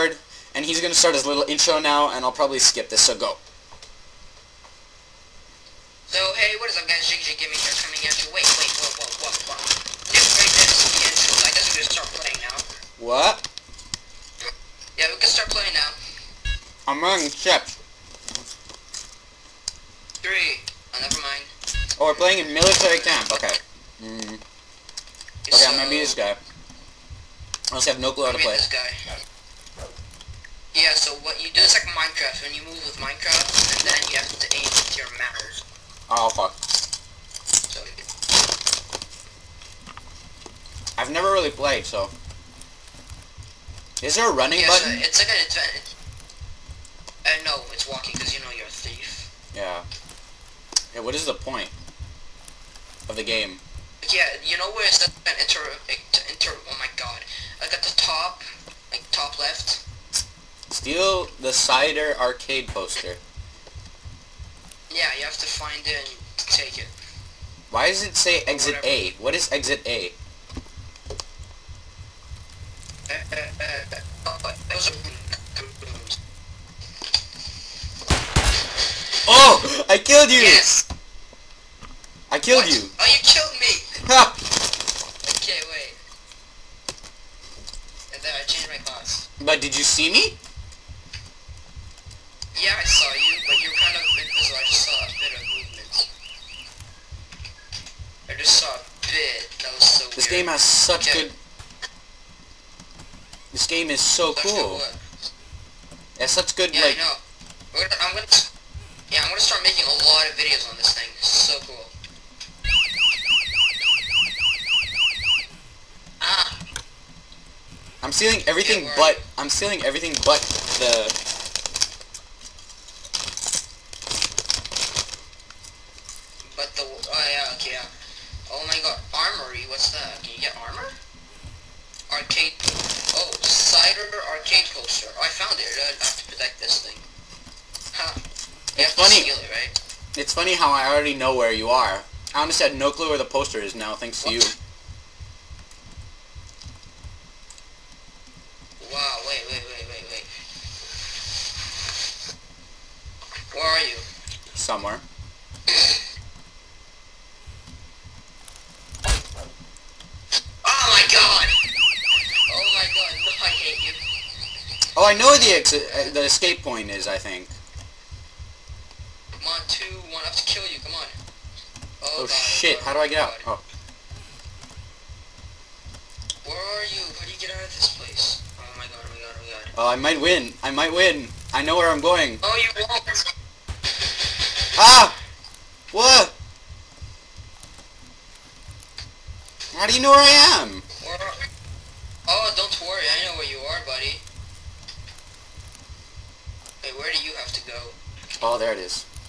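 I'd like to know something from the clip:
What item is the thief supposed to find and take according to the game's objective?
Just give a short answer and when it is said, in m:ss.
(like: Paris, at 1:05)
cider arcade poster, at 1:01.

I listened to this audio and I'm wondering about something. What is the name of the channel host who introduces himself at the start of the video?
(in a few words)
Jiggy Jiggy Gaming.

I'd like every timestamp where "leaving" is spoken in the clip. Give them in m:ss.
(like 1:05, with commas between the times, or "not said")
not said.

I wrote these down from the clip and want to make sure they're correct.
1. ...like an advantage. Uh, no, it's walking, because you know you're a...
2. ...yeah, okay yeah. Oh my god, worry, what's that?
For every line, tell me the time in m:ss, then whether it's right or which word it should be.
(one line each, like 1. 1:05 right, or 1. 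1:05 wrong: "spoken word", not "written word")
1. 0:45 right
2. 2:07 wrong: "armory", not "worry".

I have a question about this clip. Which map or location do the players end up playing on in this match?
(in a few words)
military camp.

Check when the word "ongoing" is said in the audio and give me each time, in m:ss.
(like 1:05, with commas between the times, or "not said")
not said.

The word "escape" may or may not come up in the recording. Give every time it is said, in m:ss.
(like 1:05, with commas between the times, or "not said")
2:46.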